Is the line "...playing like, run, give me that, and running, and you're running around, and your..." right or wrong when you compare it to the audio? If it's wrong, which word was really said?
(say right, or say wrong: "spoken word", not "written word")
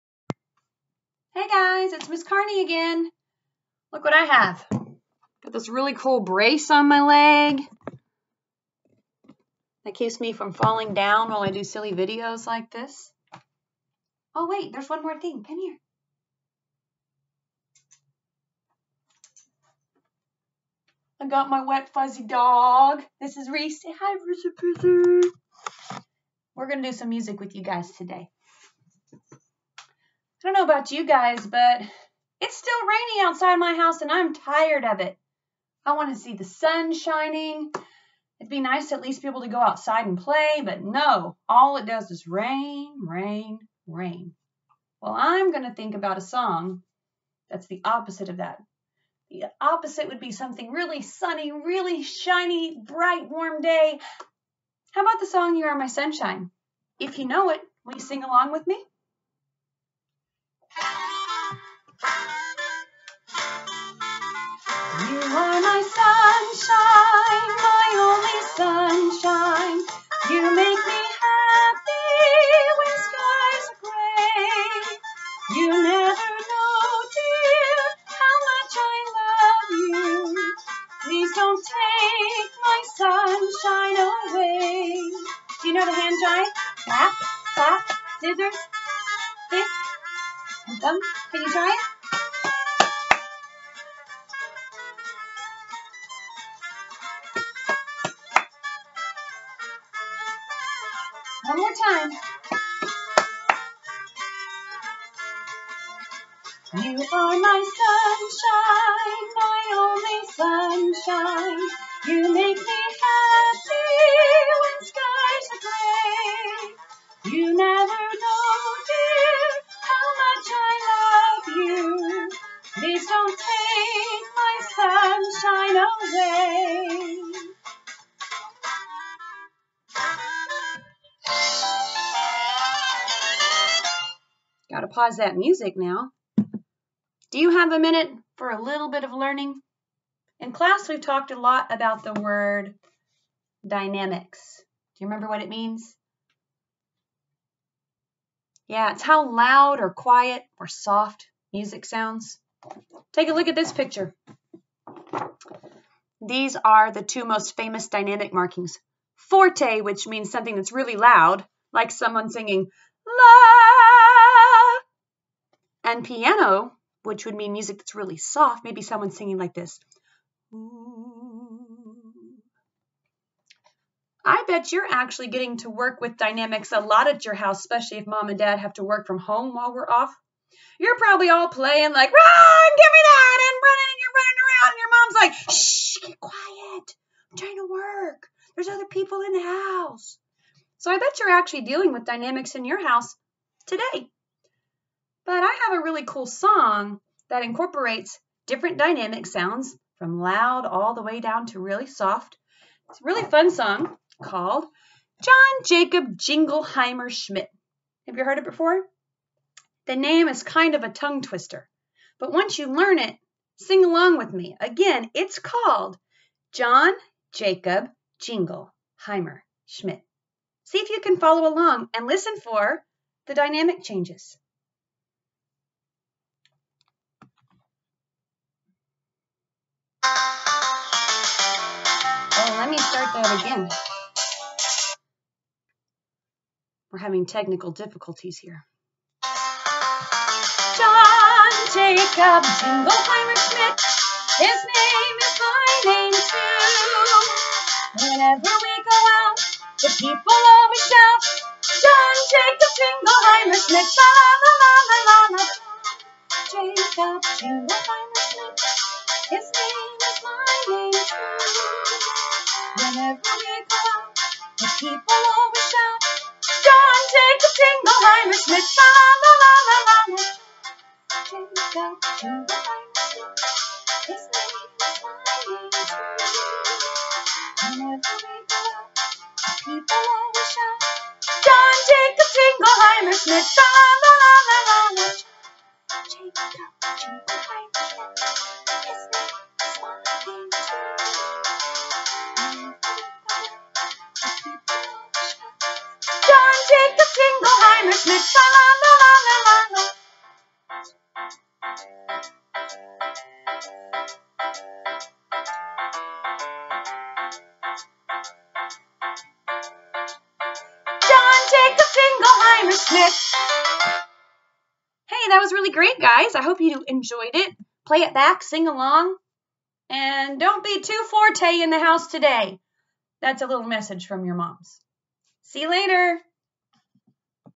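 right.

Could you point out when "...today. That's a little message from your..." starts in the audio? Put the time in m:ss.
5:22.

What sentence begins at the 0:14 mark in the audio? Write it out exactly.
Oh wait, there's one more thing.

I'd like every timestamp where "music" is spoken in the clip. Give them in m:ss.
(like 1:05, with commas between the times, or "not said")
0:27, 2:15, 2:31, 2:47.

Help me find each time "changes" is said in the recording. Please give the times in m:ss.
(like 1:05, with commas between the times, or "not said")
3:43.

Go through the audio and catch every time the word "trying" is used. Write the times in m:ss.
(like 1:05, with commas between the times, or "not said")
3:07.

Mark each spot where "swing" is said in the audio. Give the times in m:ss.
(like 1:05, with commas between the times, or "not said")
not said.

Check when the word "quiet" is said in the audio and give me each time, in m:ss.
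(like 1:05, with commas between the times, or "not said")
2:29, 3:06.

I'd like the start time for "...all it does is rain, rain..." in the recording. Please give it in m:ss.
0:41.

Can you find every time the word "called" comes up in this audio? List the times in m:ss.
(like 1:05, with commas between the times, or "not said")
3:24, 3:35.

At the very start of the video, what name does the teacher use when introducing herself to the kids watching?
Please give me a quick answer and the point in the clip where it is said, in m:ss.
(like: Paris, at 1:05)
Miss Carney, at 0:02.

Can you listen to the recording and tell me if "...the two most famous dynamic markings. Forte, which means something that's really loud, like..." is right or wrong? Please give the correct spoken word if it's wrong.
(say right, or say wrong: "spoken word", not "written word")
right.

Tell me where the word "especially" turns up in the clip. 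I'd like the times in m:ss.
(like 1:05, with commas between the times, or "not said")
2:57.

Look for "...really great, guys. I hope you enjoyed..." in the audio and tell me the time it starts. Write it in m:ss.
5:15.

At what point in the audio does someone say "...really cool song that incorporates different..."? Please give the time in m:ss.
3:15.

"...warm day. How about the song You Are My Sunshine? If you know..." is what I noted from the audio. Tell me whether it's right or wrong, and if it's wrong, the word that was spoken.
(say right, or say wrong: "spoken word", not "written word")
right.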